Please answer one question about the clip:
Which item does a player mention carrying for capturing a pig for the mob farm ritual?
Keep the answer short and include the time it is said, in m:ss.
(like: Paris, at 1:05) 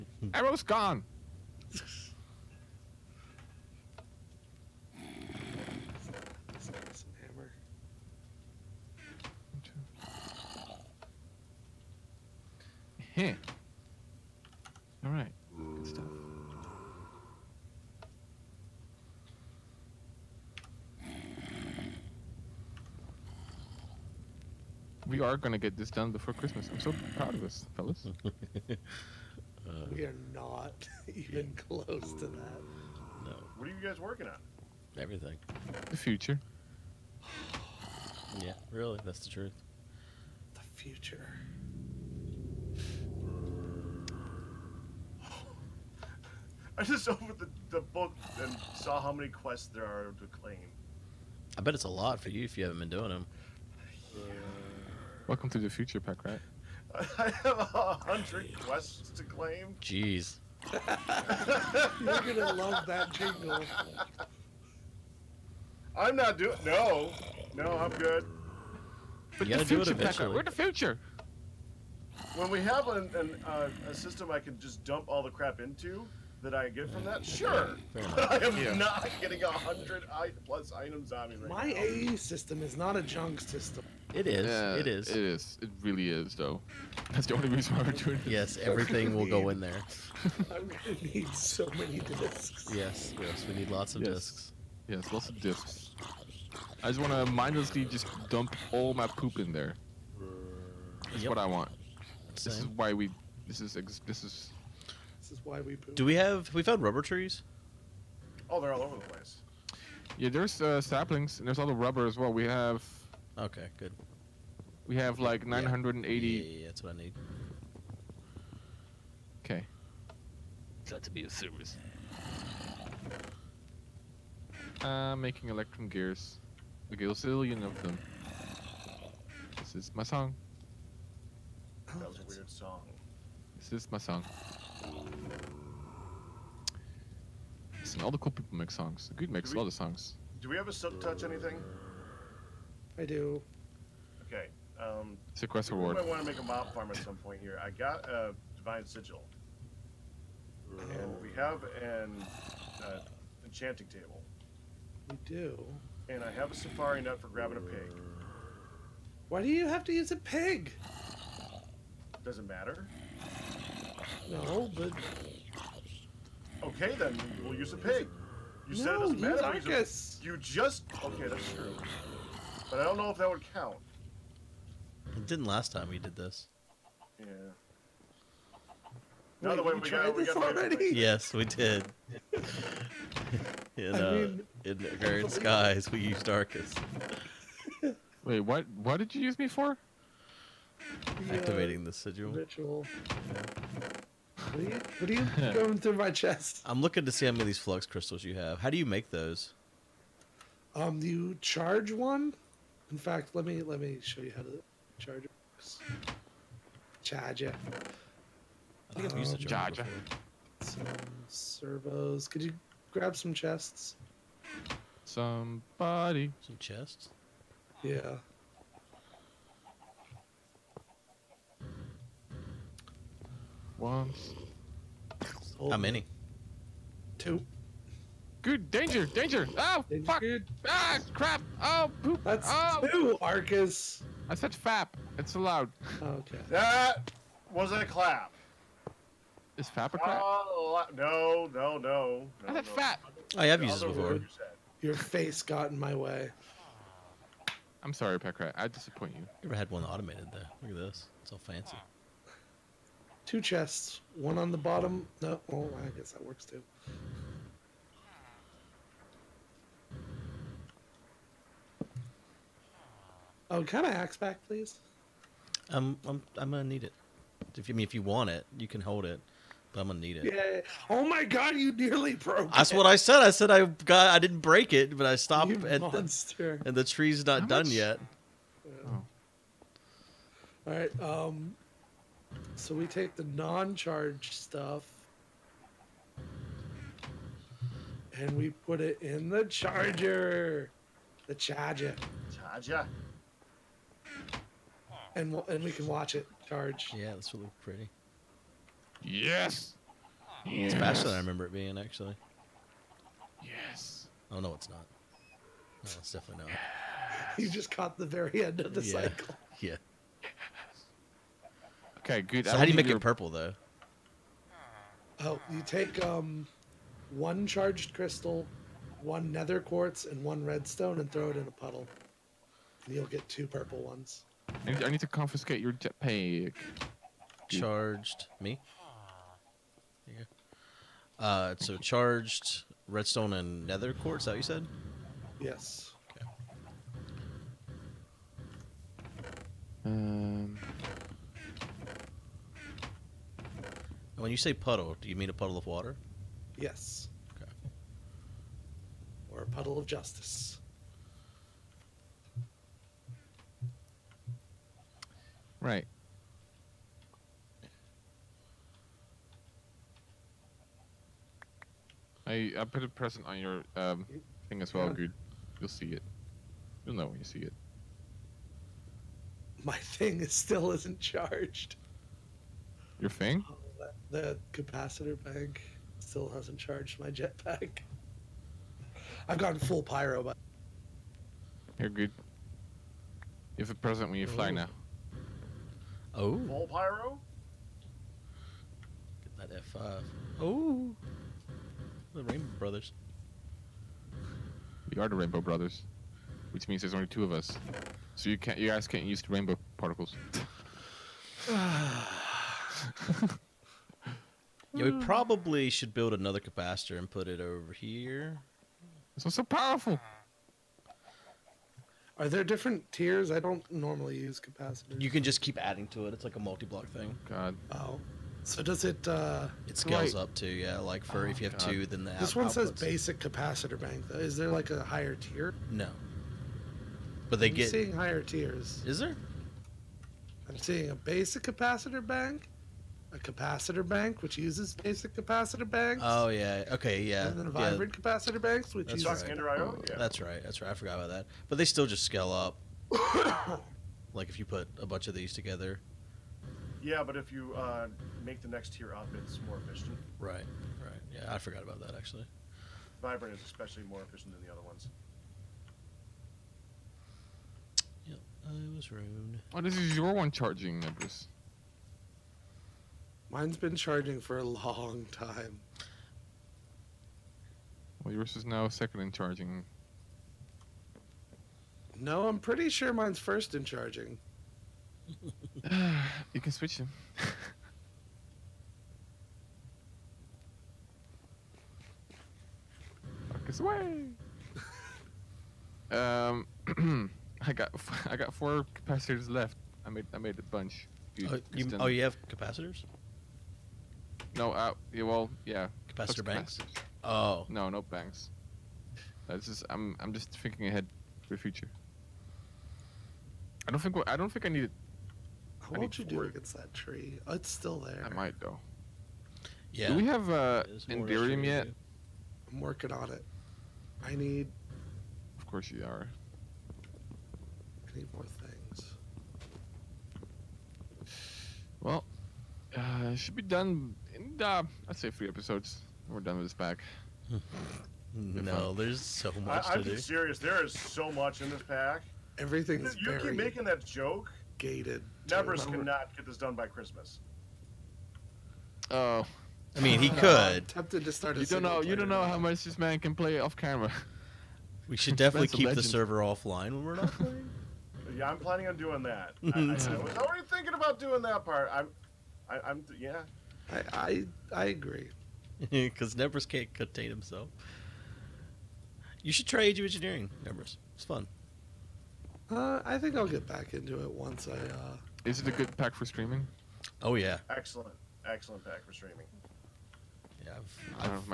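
Safari net, at 2:36.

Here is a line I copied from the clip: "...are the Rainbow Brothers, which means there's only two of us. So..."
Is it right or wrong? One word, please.
right.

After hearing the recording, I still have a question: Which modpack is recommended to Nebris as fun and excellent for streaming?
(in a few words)
Age of Engineering.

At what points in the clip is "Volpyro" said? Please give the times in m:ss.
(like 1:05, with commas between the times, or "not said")
6:26.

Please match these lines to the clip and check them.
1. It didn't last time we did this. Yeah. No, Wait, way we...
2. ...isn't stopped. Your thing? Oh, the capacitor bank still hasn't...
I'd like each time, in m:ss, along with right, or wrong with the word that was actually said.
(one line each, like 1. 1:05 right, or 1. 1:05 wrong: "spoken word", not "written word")
1. 2:55 right
2. 6:10 wrong: "charged", not "stopped".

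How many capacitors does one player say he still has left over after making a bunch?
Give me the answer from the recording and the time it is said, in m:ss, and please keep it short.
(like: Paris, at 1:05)
4, at 8:08.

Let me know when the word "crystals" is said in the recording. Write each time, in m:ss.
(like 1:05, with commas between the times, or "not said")
3:17, 5:17.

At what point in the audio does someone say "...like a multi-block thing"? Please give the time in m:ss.
6:56.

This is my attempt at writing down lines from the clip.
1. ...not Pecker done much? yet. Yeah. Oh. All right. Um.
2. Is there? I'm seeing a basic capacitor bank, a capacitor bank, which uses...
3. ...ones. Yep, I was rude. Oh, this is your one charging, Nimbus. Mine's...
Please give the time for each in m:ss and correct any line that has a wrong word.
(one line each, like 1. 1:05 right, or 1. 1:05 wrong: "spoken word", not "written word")
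1. 4:37 wrong: "How", not "Pecker"
2. 7:08 right
3. 7:34 right.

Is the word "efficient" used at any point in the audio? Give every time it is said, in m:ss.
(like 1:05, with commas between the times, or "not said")
7:29, 7:34.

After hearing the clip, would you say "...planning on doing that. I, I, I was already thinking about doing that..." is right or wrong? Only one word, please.
right.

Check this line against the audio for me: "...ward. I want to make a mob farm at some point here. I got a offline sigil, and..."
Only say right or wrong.
wrong.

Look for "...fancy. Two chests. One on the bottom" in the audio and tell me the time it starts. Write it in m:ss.
4:11.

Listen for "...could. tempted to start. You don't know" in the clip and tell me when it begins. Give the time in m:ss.
9:00.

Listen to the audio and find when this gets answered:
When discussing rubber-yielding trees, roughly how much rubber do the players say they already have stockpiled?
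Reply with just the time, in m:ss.
1:55.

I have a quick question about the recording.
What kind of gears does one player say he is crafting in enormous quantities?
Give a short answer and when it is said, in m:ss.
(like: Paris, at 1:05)
Electrum gears, at 2:05.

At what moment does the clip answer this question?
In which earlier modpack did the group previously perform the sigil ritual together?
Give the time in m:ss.
3:04.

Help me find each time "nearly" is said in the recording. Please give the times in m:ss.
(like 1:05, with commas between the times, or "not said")
4:31.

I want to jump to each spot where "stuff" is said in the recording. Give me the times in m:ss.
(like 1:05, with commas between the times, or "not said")
4:44.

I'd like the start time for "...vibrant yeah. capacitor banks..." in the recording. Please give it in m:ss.
7:17.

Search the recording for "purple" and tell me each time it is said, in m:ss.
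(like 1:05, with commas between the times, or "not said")
5:12, 5:23.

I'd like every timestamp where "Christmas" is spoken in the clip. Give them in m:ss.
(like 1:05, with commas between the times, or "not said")
0:26, 8:56.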